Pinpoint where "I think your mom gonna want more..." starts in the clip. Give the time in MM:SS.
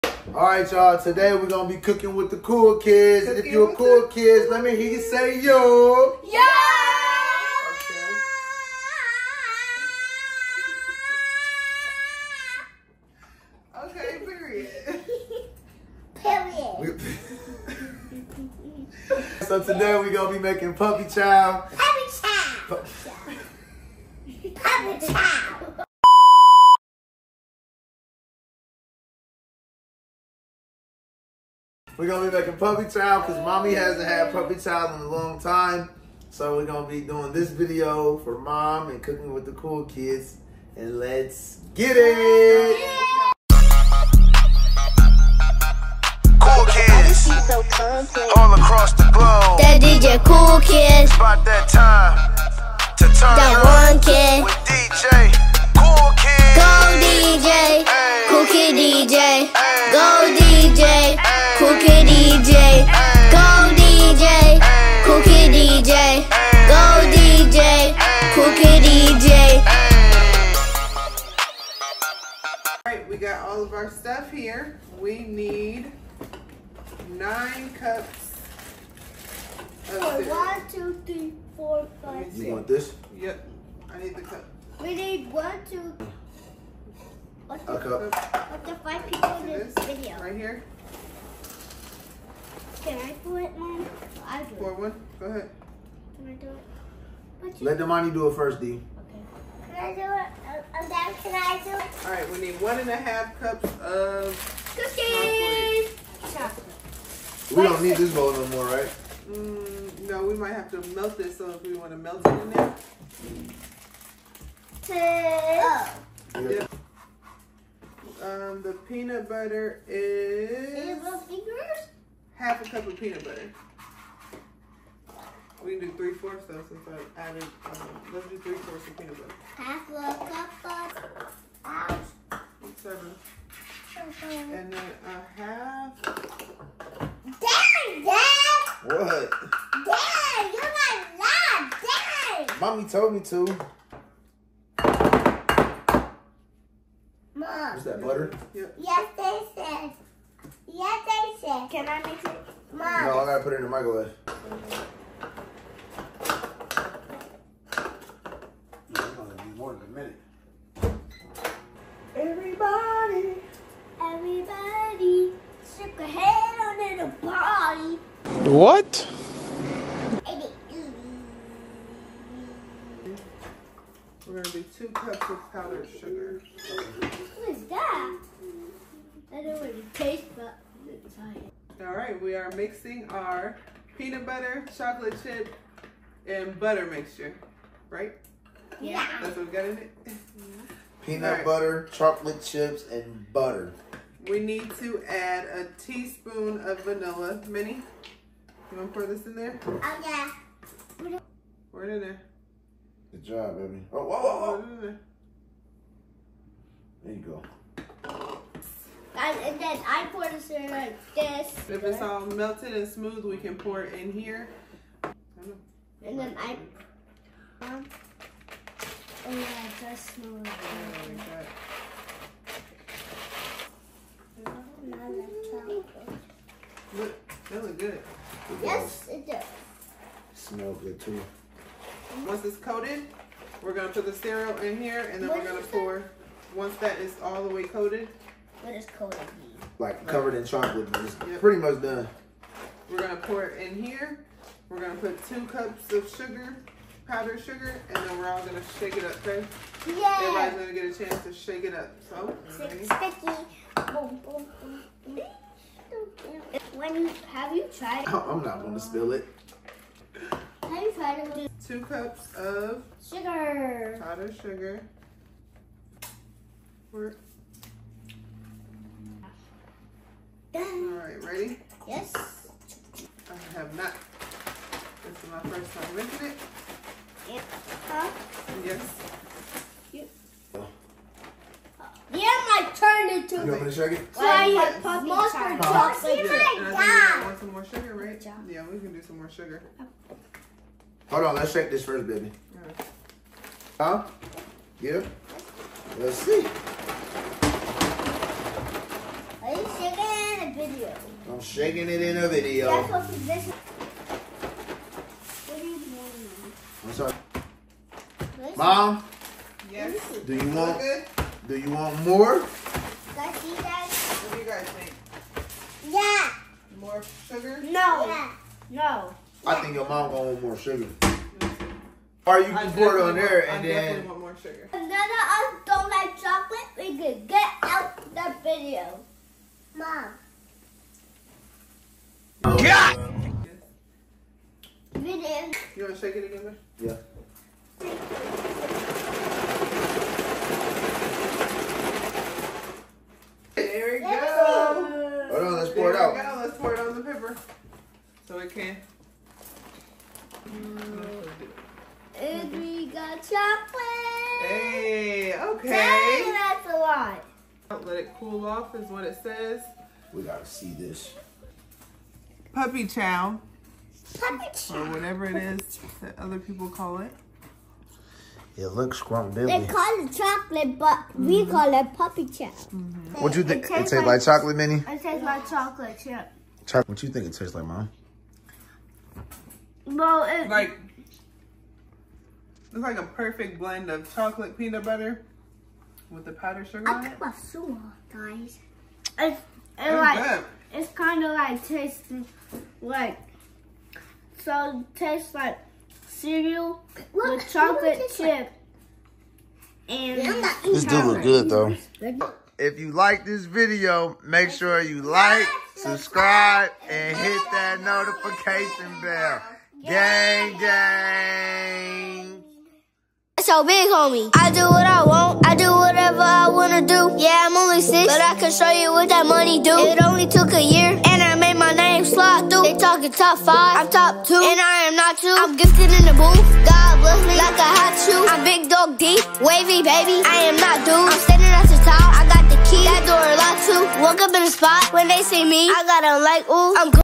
05:19.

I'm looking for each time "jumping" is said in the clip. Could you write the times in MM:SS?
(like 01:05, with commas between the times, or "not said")
not said.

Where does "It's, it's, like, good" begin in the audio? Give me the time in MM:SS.
06:29.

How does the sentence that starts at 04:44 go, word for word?
Well, you have puppy monster chocolate.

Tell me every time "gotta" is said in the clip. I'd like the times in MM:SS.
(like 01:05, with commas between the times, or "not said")
02:33, 06:00.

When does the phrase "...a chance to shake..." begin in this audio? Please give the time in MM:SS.
04:10.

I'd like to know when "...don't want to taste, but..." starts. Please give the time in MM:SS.
02:59.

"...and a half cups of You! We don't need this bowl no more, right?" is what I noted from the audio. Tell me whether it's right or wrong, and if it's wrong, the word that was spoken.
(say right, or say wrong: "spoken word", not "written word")
wrong: "Cookies", not "You".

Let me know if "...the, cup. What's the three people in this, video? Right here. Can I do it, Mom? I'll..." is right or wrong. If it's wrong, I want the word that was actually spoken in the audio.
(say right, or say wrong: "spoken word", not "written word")
wrong: "five", not "three".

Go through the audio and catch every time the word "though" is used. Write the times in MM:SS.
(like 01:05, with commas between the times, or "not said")
02:06, 06:41.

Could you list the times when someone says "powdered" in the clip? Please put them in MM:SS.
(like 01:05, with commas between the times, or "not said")
02:55, 04:07, 04:24, 06:26.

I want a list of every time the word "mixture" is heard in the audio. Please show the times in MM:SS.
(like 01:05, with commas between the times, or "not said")
03:06.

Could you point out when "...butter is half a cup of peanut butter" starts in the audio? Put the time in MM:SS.
01:59.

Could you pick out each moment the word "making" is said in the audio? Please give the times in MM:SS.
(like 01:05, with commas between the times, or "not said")
00:20, 00:32, 04:35.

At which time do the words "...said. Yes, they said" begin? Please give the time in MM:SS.
02:29.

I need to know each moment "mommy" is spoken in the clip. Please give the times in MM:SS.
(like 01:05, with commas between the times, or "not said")
00:33, 02:22.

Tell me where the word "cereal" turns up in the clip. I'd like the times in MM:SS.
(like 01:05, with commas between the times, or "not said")
03:54, 06:36.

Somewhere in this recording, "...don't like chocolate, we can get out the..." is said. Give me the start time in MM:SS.
05:25.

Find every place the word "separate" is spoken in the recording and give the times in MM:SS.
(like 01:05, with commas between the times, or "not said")
not said.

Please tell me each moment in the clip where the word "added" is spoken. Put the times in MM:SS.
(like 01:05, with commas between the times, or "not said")
02:07.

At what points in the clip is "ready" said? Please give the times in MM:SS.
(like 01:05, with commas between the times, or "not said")
04:31.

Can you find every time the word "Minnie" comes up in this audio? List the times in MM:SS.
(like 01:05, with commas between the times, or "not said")
03:17, 06:14.